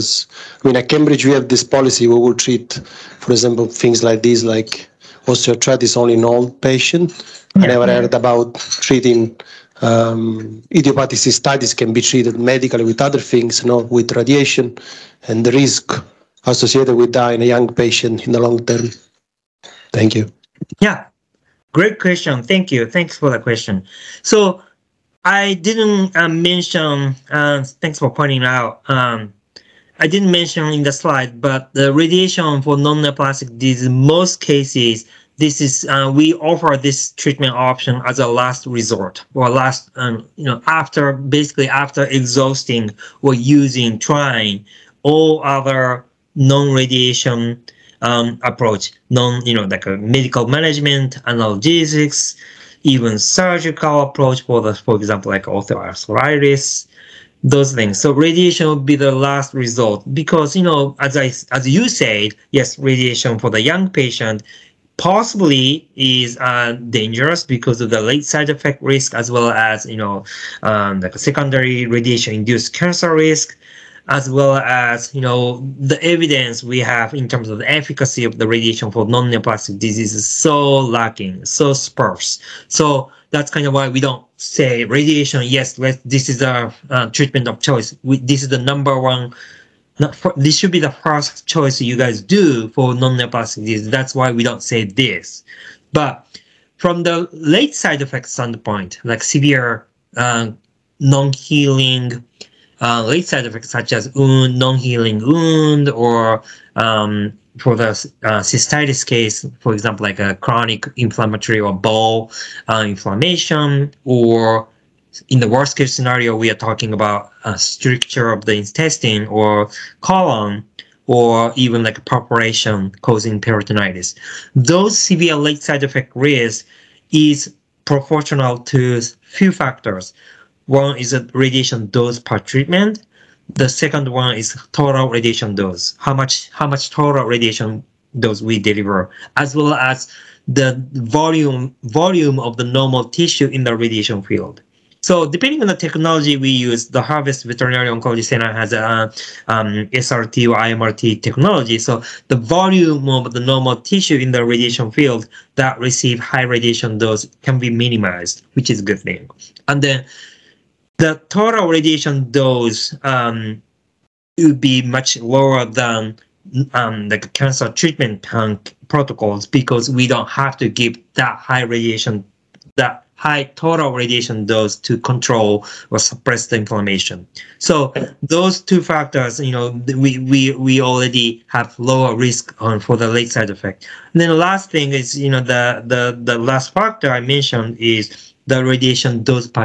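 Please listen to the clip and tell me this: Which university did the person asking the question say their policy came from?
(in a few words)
Cambridge.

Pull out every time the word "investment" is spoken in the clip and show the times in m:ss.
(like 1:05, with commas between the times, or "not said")
not said.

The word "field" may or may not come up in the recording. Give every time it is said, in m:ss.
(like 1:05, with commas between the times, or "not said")
2:24, 2:34.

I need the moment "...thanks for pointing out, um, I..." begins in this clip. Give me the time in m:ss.
0:27.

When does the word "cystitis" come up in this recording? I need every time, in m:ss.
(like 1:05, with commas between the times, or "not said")
0:11, 1:48.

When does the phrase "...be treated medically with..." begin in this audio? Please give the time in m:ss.
0:11.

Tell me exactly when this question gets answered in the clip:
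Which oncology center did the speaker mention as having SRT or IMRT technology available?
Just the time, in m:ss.
2:27.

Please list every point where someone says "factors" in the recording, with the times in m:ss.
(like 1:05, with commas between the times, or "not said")
2:09, 2:58, 3:06.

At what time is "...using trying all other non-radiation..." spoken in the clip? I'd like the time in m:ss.
0:43.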